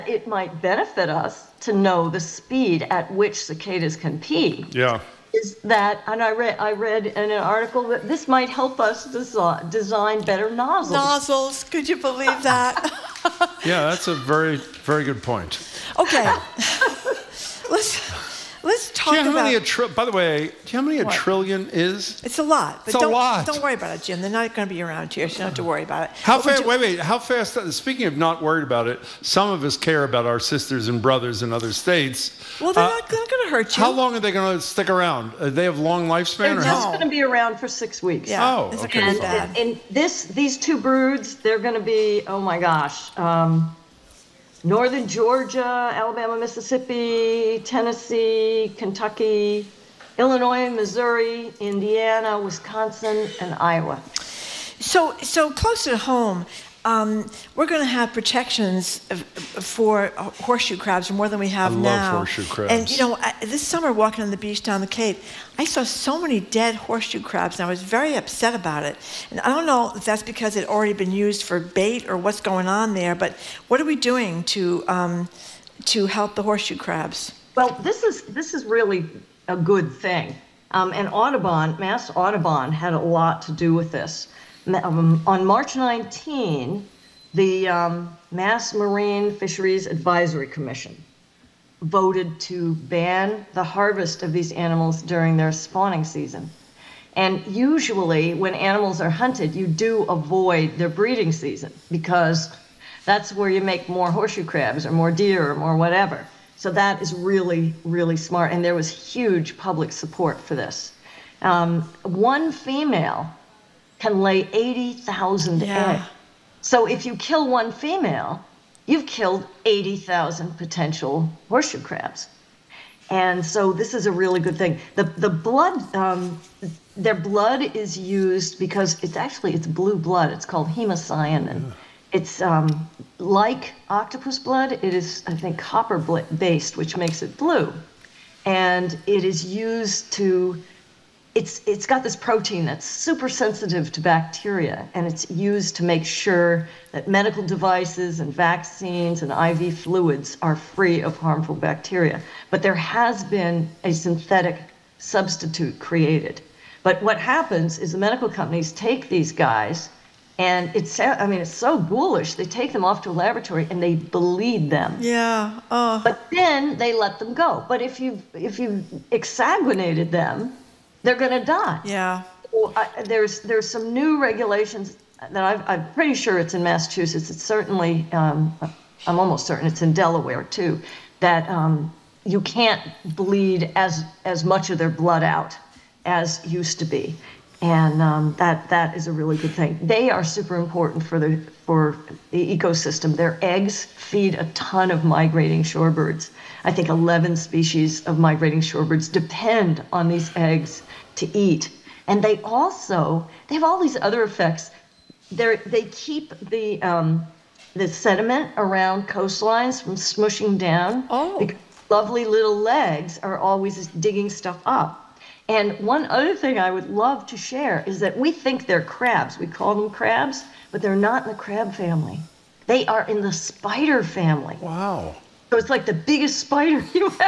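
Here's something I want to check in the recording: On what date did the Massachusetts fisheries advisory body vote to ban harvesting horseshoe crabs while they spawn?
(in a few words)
March 19.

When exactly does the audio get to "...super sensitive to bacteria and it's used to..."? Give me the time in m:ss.
2:22.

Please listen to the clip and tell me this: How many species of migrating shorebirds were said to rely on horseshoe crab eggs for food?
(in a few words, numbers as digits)
11.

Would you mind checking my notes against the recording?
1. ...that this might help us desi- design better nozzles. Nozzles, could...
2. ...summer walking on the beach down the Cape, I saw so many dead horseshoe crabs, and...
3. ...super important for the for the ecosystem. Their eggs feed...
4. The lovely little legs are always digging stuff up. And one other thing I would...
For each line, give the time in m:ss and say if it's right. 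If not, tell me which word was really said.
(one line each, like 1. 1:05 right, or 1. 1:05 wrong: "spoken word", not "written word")
1. 0:07 right
2. 1:03 right
3. 3:10 right
4. 3:31 right.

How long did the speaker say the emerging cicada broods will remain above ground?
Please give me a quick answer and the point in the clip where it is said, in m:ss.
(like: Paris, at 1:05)
6 weeks, at 0:37.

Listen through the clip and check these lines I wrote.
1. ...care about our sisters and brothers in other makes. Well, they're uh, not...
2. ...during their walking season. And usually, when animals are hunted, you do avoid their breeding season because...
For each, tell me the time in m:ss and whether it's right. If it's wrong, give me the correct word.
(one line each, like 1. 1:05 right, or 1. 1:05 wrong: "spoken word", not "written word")
1. 0:29 wrong: "states", not "makes"
2. 1:35 wrong: "spawning", not "walking".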